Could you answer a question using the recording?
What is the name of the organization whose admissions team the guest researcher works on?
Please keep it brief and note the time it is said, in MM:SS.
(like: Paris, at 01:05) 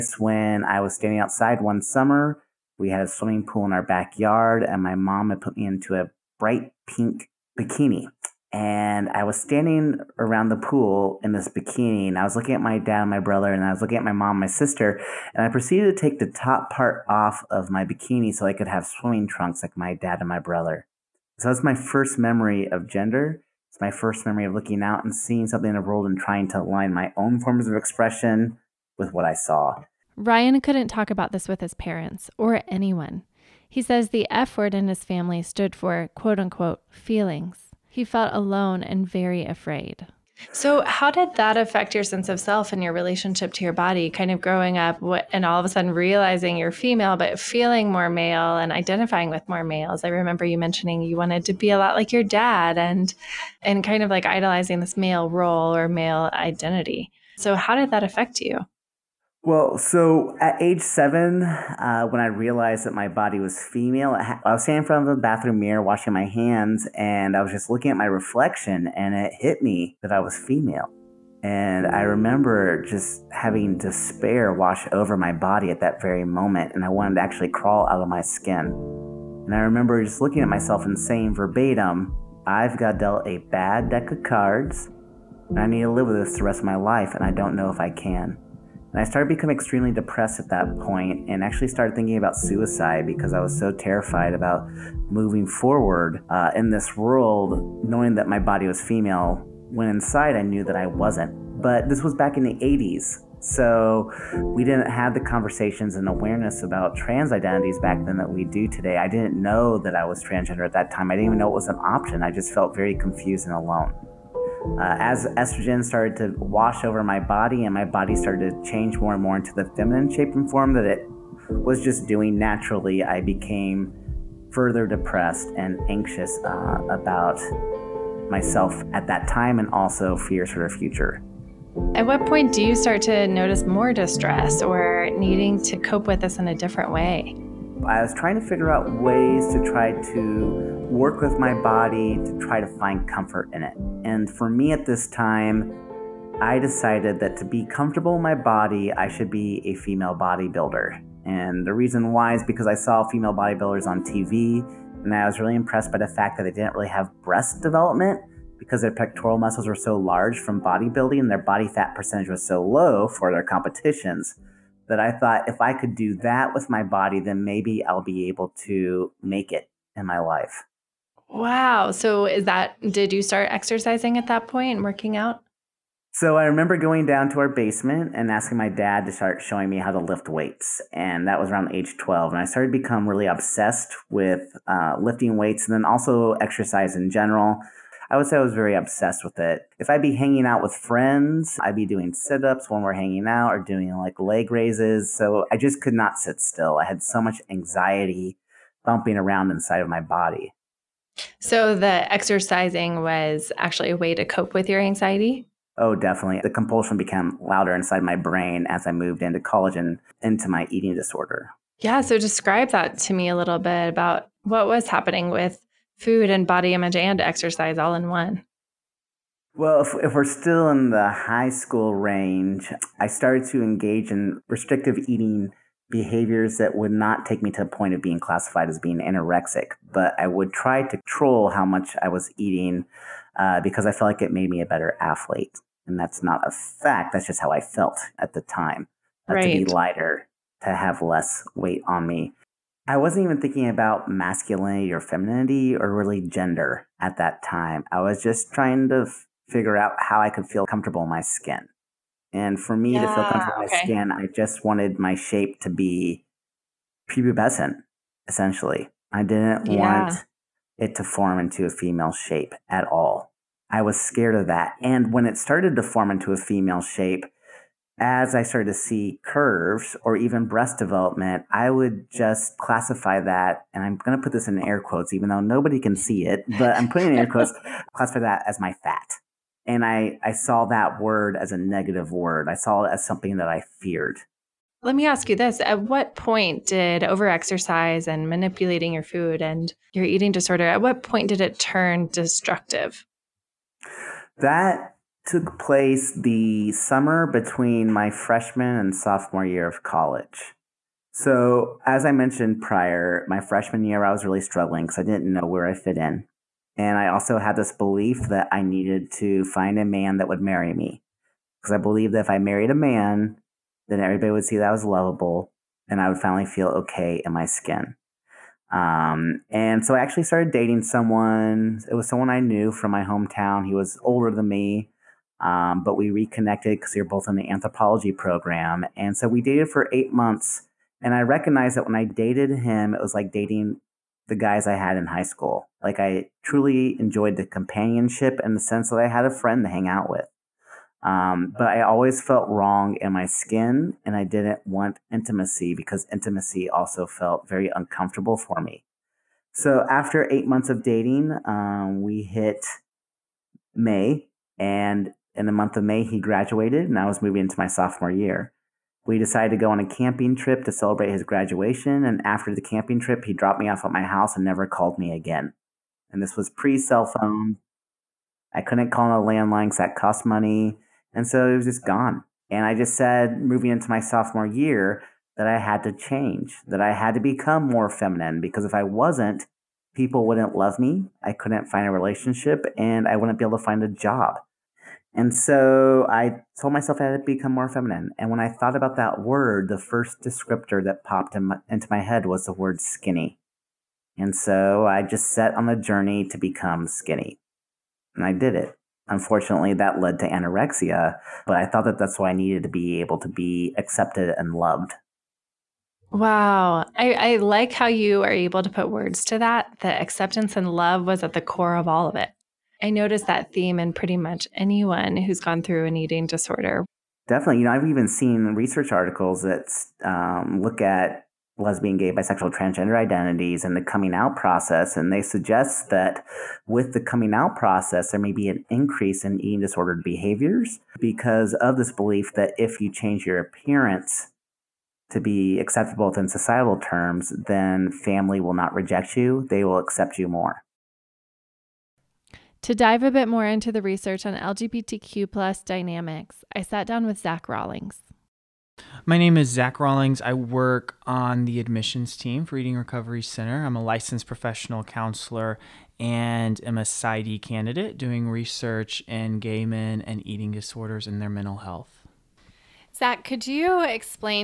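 Eating Recovery Center, at 07:32.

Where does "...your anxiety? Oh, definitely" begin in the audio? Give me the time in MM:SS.
03:24.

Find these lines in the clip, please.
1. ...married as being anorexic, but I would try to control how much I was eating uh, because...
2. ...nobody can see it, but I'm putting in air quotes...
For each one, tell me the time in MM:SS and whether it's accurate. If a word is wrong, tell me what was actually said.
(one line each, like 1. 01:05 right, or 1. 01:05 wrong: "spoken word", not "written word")
1. 03:48 wrong: "classified", not "married"
2. 04:35 right.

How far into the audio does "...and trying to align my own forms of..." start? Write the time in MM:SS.
00:26.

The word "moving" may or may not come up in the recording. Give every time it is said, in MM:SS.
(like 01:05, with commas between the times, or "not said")
01:35, 05:57, 06:13.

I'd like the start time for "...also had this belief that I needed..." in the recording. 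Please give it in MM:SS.
05:07.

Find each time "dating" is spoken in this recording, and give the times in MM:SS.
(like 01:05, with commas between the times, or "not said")
05:20, 05:33, 05:50.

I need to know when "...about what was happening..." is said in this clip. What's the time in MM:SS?
03:33.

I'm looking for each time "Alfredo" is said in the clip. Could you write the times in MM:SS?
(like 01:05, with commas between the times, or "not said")
not said.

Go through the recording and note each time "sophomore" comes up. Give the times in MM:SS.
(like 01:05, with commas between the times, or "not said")
04:58, 05:57, 06:13.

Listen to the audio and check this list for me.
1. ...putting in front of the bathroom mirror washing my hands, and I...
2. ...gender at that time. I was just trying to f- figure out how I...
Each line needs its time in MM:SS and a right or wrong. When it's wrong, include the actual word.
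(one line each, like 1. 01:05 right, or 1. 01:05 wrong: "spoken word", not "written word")
1. 01:04 wrong: "standing", not "putting"
2. 04:06 right.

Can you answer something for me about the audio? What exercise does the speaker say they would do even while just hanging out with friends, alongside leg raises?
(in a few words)
sit ups.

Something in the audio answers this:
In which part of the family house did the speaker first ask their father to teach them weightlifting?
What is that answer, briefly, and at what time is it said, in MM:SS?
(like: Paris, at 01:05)
basement, at 02:57.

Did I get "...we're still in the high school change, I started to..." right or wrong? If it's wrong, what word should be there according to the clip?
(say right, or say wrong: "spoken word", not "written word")
wrong: "range", not "change".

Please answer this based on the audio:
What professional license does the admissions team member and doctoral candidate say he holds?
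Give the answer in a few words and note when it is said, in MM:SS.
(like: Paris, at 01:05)
licensed professional counselor, at 07:33.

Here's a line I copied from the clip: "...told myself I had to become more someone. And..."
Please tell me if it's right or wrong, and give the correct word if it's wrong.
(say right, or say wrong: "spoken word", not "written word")
wrong: "feminine", not "someone".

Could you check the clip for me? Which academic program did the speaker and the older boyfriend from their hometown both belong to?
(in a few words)
anthropology.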